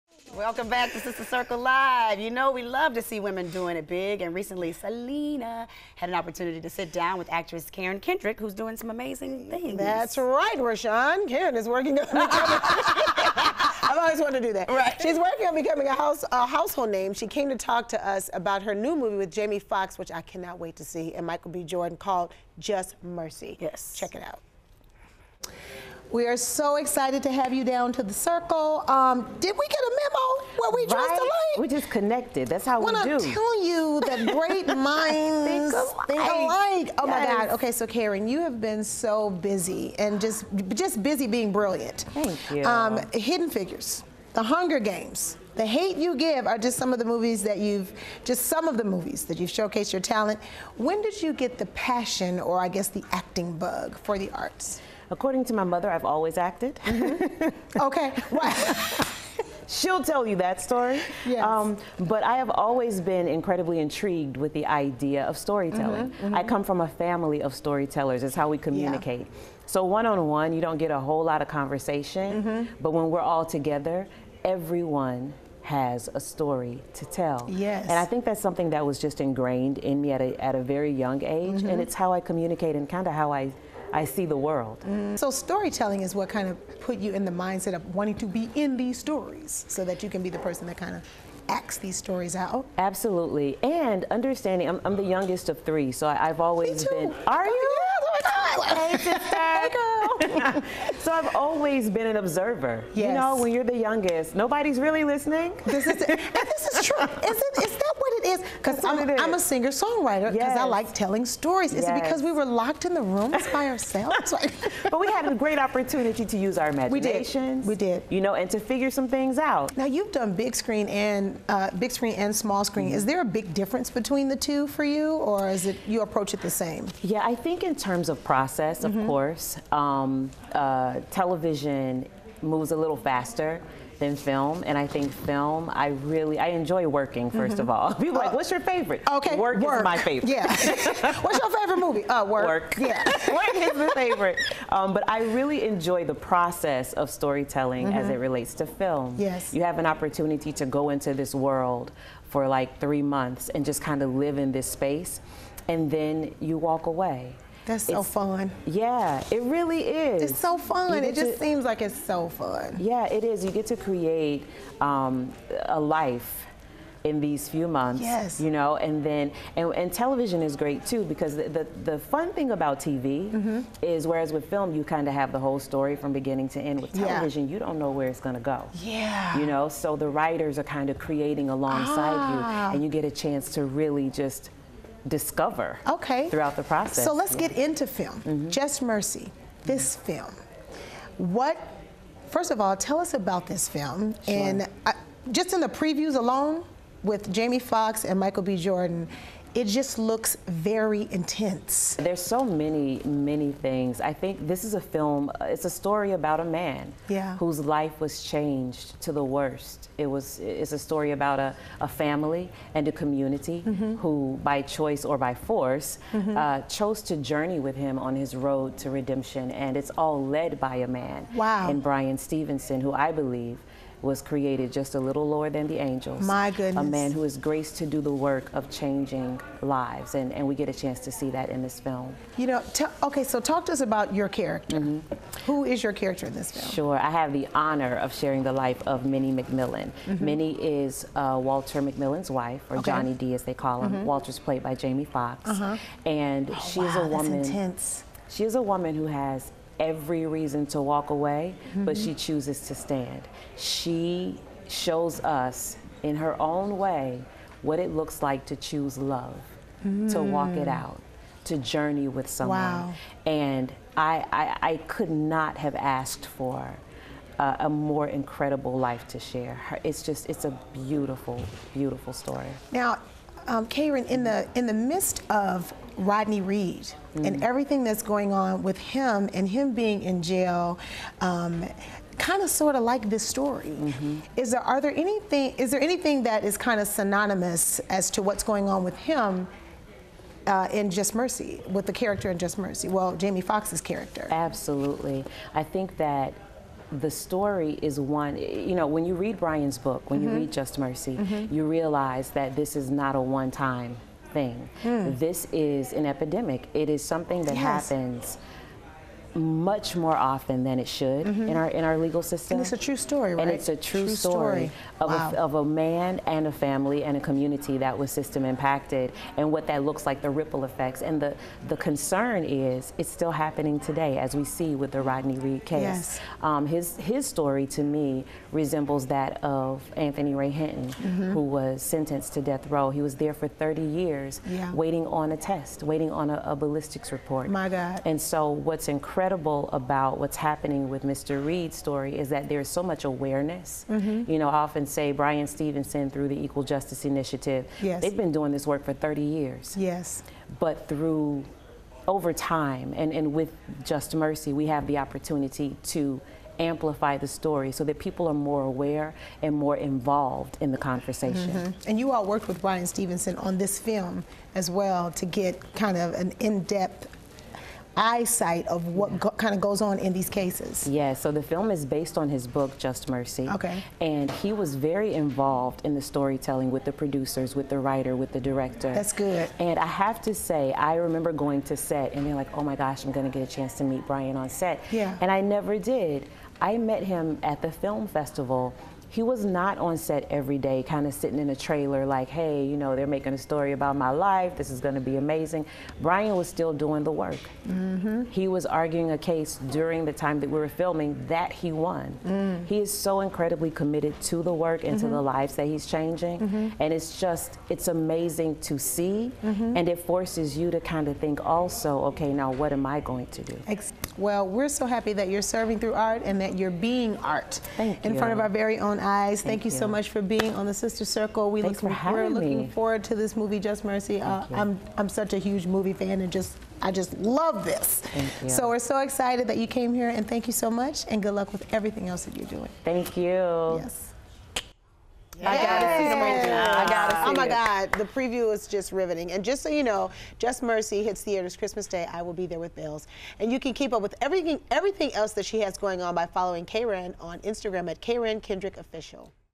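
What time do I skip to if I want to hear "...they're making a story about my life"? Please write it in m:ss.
6:32.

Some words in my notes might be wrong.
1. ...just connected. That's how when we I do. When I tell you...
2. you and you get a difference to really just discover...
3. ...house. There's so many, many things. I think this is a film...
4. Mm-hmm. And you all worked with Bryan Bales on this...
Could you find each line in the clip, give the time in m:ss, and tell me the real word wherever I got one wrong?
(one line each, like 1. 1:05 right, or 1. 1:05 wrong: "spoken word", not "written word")
1. 0:31 right
2. 3:02 wrong: "chance", not "difference"
3. 3:21 wrong: "intense", not "house"
4. 6:01 wrong: "Stevenson", not "Bales".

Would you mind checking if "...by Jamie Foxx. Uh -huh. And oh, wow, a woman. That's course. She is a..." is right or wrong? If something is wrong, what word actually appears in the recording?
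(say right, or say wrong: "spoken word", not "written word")
wrong: "intense", not "course".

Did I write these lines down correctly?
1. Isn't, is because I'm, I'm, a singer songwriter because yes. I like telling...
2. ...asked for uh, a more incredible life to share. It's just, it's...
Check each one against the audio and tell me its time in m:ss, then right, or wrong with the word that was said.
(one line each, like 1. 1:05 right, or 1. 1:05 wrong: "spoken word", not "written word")
1. 1:47 right
2. 4:25 right.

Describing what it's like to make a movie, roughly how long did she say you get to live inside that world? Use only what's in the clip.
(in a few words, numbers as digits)
3 months.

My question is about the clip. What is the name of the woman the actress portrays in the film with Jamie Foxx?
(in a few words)
Minnie McMillian.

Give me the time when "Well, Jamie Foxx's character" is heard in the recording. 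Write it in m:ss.
4:52.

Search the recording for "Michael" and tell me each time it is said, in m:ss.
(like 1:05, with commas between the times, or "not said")
0:21, 3:18.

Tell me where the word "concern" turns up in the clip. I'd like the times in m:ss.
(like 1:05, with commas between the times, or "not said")
5:21.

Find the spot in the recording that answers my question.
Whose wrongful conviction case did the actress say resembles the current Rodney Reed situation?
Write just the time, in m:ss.
5:29.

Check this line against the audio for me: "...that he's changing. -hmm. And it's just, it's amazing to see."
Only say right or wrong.
right.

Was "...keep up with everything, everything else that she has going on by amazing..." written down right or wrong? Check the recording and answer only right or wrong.
wrong.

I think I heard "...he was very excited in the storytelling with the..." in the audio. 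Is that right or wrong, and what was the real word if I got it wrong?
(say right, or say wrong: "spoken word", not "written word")
wrong: "involved", not "excited".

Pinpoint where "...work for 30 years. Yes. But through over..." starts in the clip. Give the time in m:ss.
5:48.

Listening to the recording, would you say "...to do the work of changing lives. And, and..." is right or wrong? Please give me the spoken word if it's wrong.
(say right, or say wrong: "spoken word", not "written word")
right.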